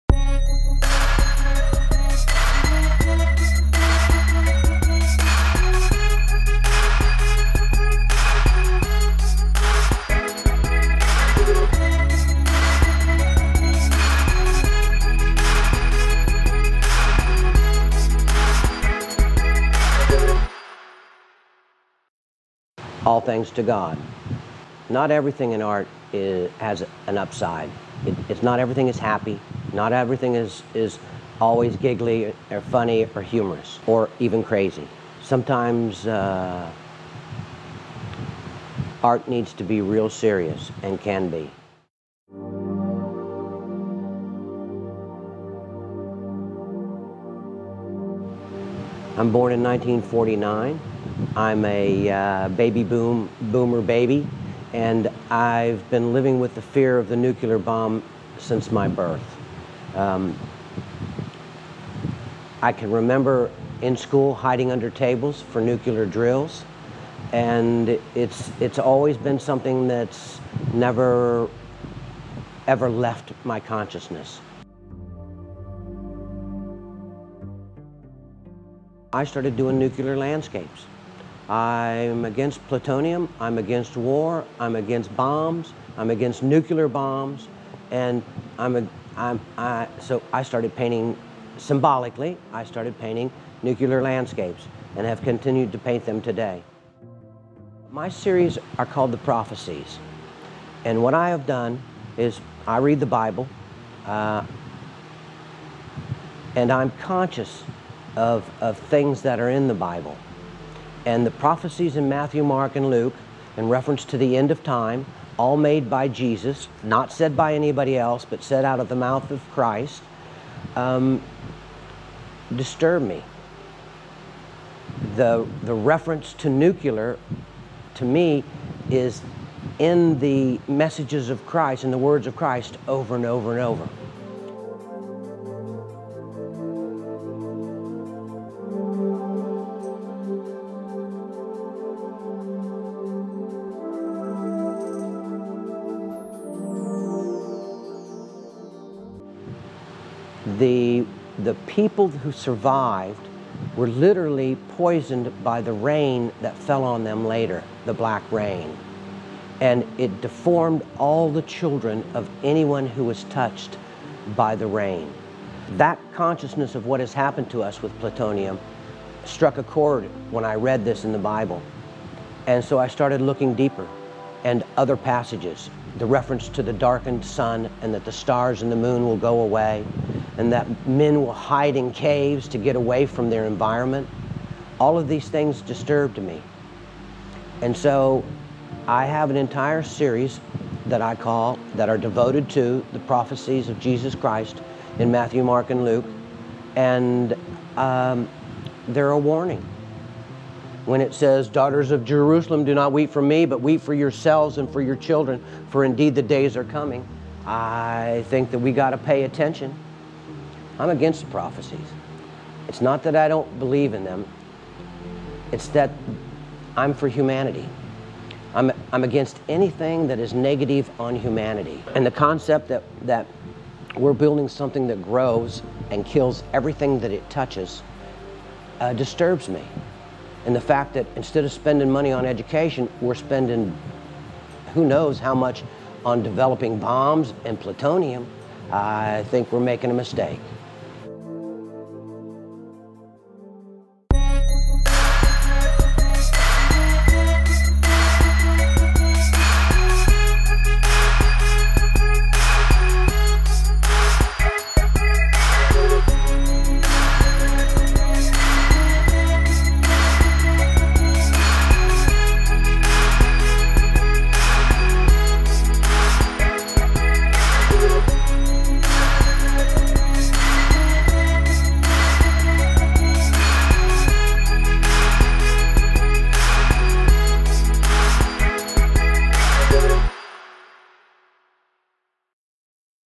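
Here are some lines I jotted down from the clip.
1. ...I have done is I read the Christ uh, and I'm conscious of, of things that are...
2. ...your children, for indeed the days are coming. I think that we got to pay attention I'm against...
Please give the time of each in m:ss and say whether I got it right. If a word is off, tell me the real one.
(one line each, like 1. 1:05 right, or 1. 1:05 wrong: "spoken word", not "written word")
1. 1:41 wrong: "Bible", not "Christ"
2. 3:24 right.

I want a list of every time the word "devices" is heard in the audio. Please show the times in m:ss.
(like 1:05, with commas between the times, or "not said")
not said.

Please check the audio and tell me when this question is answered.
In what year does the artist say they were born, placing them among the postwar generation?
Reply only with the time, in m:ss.
0:49.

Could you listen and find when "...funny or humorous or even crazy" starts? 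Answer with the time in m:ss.
0:32.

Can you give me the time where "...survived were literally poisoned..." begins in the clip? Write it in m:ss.
2:32.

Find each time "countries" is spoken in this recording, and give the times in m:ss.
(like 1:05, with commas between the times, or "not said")
not said.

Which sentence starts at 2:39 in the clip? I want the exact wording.
And it deformed all the children of anyone who was touched by the rain.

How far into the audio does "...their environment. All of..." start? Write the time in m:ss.
3:03.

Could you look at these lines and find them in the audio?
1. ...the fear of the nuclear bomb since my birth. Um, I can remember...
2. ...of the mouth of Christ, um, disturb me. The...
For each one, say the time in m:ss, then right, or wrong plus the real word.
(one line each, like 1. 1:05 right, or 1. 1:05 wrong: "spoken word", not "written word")
1. 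0:56 right
2. 1:58 right.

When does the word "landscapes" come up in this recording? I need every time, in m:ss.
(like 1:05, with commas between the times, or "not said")
1:20, 1:34.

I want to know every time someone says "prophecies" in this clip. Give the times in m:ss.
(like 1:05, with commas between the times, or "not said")
1:39, 1:51, 3:13, 3:31.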